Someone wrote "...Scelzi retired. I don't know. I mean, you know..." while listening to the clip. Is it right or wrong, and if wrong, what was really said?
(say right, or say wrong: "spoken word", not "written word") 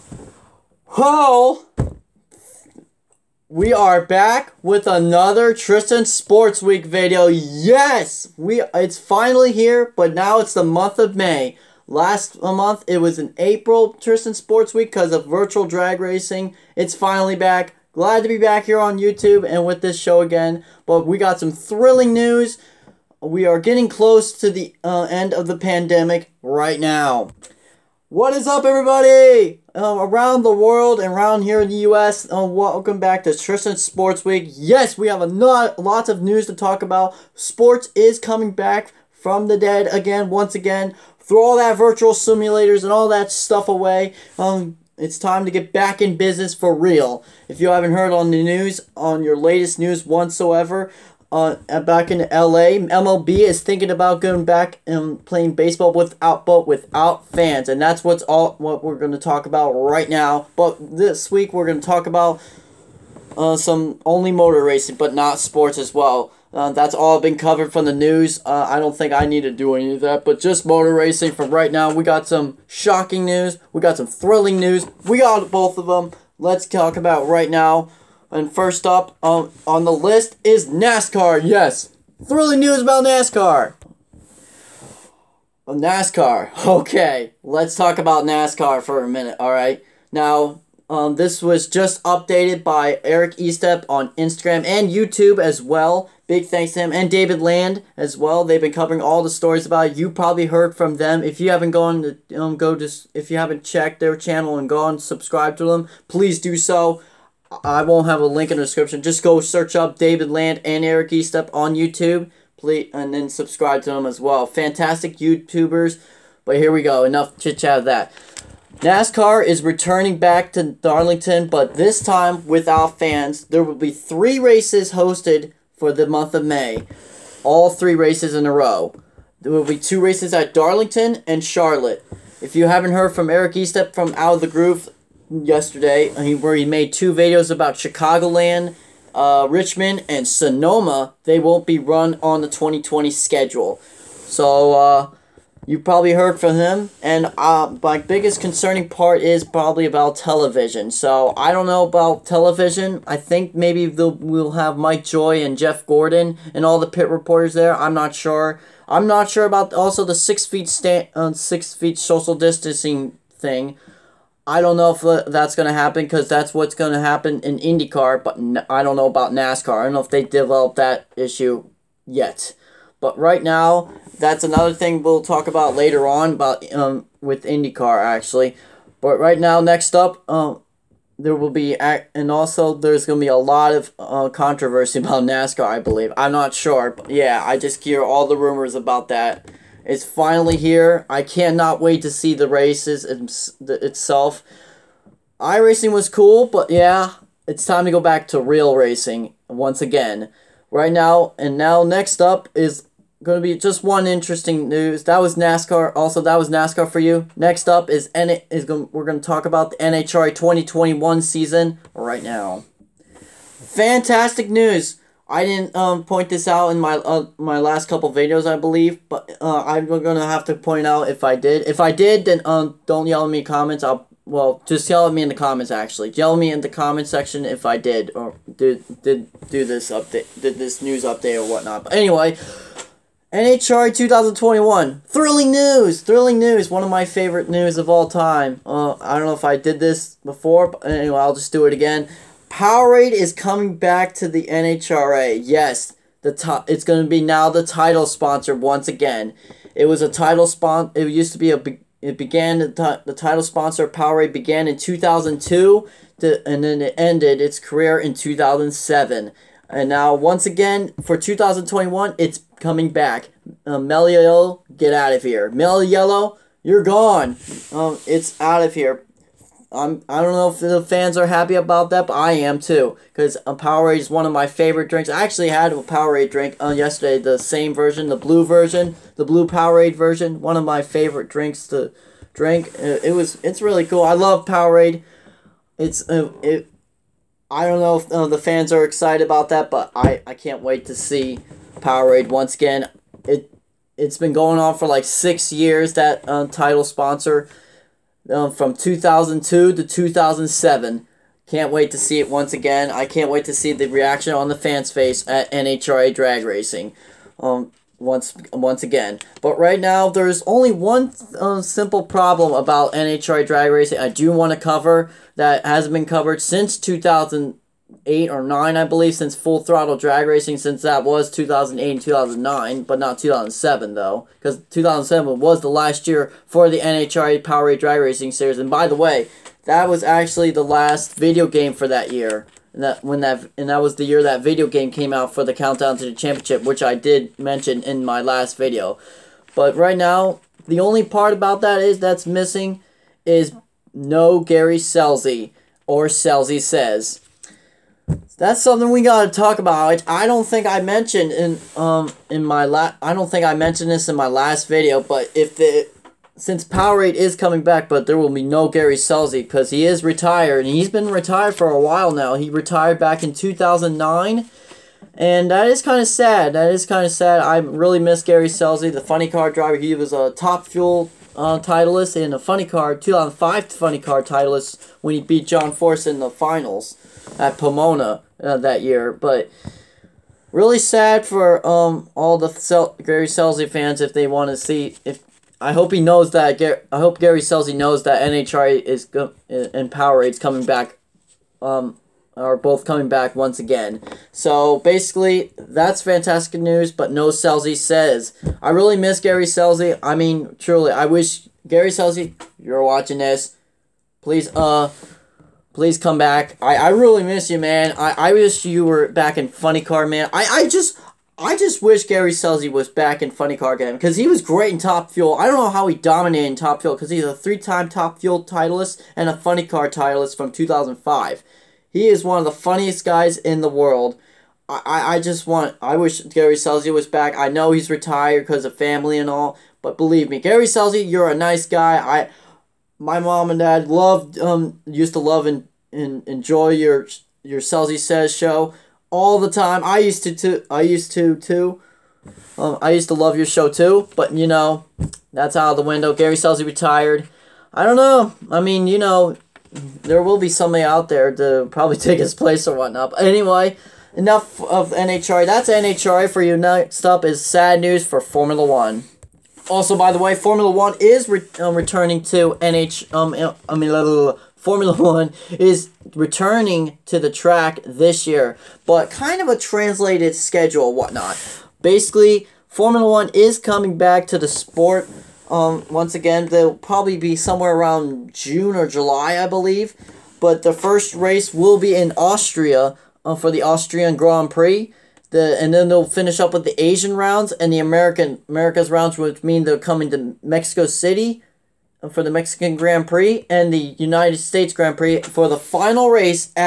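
right.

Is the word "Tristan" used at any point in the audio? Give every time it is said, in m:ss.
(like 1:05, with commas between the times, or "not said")
0:05, 0:13, 0:33.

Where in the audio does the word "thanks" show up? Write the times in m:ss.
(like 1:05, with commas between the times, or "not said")
1:36.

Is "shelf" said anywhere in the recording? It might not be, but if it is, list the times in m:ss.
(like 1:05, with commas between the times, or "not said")
not said.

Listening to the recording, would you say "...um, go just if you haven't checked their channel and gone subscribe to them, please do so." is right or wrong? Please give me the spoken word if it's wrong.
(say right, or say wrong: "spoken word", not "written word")
right.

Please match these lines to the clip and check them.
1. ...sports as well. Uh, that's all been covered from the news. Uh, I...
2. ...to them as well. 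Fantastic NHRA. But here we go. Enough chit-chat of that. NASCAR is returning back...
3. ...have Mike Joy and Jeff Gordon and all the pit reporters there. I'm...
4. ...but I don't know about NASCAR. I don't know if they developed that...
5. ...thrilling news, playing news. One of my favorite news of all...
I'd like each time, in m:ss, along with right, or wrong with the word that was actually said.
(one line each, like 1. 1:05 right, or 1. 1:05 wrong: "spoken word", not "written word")
1. 1:05 right
2. 1:53 wrong: "YouTubers", not "NHRA"
3. 2:34 right
4. 2:48 right
5. 3:55 wrong: "thrilling", not "playing".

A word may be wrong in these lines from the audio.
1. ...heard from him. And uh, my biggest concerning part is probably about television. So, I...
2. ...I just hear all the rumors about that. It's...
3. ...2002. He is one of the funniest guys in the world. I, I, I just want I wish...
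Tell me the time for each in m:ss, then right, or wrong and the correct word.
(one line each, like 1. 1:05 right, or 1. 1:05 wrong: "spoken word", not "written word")
1. 2:26 right
2. 3:07 right
3. 7:00 wrong: "2005", not "2002".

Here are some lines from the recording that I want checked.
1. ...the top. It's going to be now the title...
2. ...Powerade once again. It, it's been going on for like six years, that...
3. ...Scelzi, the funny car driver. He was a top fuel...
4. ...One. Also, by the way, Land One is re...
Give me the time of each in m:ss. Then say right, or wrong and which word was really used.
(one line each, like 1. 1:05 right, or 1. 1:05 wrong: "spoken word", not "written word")
1. 4:06 right
2. 4:51 right
3. 6:08 right
4. 7:38 wrong: "Formula", not "Land".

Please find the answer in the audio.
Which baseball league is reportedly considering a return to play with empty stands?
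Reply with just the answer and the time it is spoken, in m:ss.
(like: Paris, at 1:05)
MLB, at 0:52.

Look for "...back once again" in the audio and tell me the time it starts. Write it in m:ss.
6:33.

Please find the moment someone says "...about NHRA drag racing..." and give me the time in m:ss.
5:12.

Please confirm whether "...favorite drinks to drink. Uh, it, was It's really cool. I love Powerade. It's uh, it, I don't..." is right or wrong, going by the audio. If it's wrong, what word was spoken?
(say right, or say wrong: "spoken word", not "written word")
right.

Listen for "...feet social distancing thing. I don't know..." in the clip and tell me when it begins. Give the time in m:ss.
2:41.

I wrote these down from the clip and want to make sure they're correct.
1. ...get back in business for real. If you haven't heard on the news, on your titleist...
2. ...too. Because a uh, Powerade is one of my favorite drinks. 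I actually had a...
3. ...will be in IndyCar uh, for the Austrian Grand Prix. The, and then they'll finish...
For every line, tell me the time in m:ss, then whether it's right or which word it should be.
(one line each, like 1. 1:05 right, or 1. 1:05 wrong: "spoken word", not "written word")
1. 0:45 wrong: "latest", not "titleist"
2. 4:32 right
3. 8:01 wrong: "Austria", not "IndyCar".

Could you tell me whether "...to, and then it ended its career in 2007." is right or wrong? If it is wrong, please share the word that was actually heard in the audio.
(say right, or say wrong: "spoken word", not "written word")
right.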